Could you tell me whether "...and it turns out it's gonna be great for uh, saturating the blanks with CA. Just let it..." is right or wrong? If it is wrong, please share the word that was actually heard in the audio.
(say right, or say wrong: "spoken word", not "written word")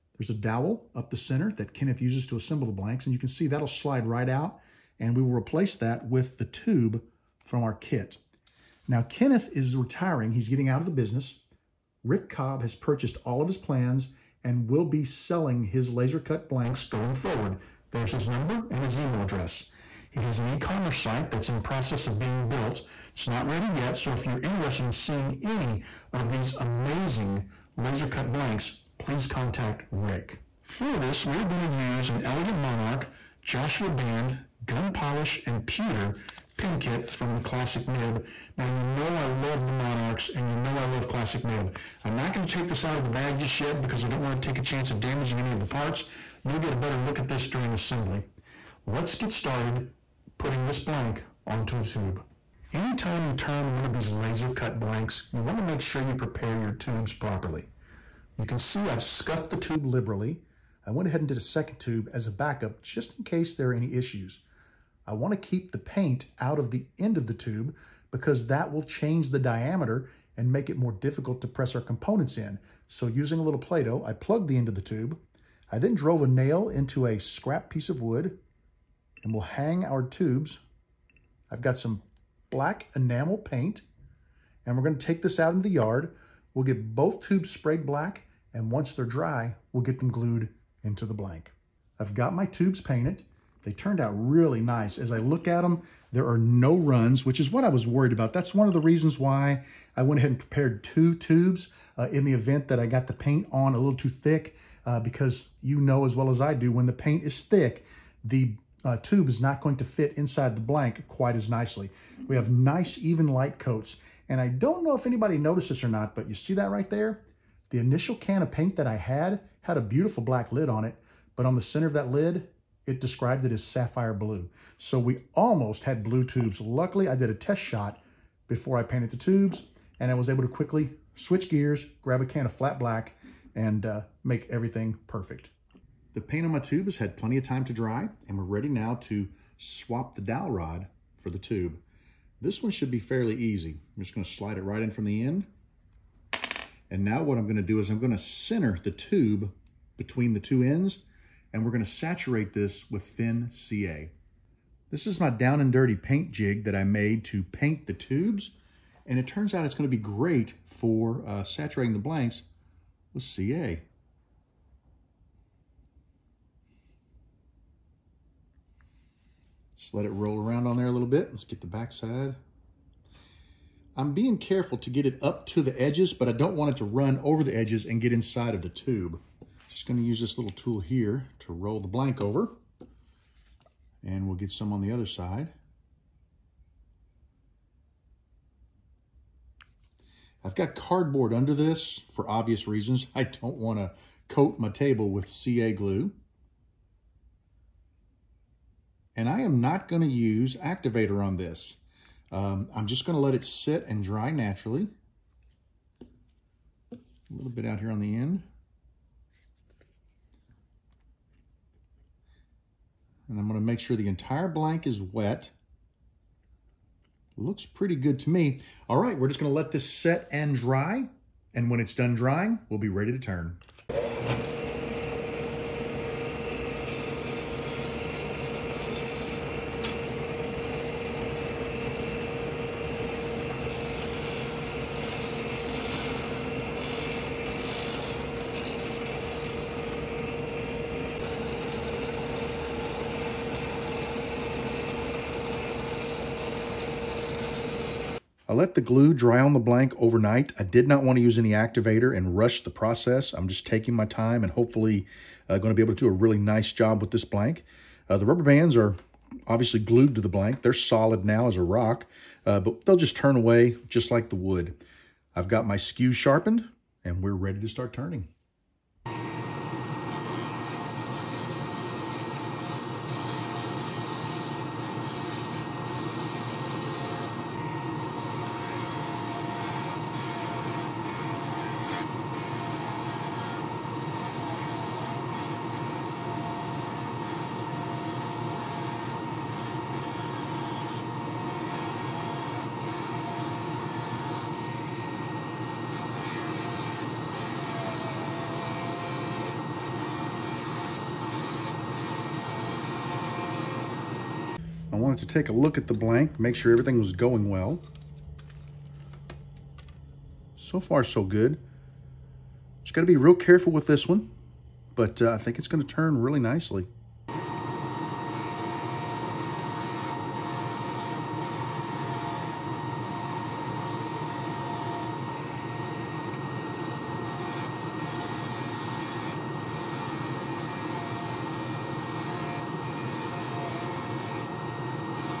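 right.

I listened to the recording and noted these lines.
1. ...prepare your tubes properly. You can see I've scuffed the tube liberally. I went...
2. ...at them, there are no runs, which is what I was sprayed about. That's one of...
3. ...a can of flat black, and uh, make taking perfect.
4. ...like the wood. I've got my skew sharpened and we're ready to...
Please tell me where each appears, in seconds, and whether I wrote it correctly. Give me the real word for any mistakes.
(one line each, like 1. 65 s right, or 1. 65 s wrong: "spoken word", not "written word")
1. 56 s right
2. 95 s wrong: "worried", not "sprayed"
3. 132 s wrong: "everything", not "taking"
4. 264 s right.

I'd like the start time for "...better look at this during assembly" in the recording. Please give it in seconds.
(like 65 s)
46 s.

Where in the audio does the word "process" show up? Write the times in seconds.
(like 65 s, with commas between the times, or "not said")
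21 s, 252 s.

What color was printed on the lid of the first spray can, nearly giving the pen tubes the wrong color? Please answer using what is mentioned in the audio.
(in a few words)
sapphire blue.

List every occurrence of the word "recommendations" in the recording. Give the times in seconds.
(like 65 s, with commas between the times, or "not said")
not said.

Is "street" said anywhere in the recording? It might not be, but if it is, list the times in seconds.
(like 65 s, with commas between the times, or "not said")
not said.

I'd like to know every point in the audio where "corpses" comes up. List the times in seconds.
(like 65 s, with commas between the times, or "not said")
not said.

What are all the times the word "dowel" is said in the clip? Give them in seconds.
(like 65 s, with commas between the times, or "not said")
0 s, 140 s.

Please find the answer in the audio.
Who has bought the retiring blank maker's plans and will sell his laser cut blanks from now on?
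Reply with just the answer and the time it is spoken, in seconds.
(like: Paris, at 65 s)
Rick Cobb, at 12 s.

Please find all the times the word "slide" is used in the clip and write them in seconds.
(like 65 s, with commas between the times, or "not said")
3 s, 144 s.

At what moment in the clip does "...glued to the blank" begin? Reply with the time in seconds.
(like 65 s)
259 s.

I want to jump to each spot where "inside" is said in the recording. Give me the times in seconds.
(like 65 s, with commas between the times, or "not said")
110 s, 178 s.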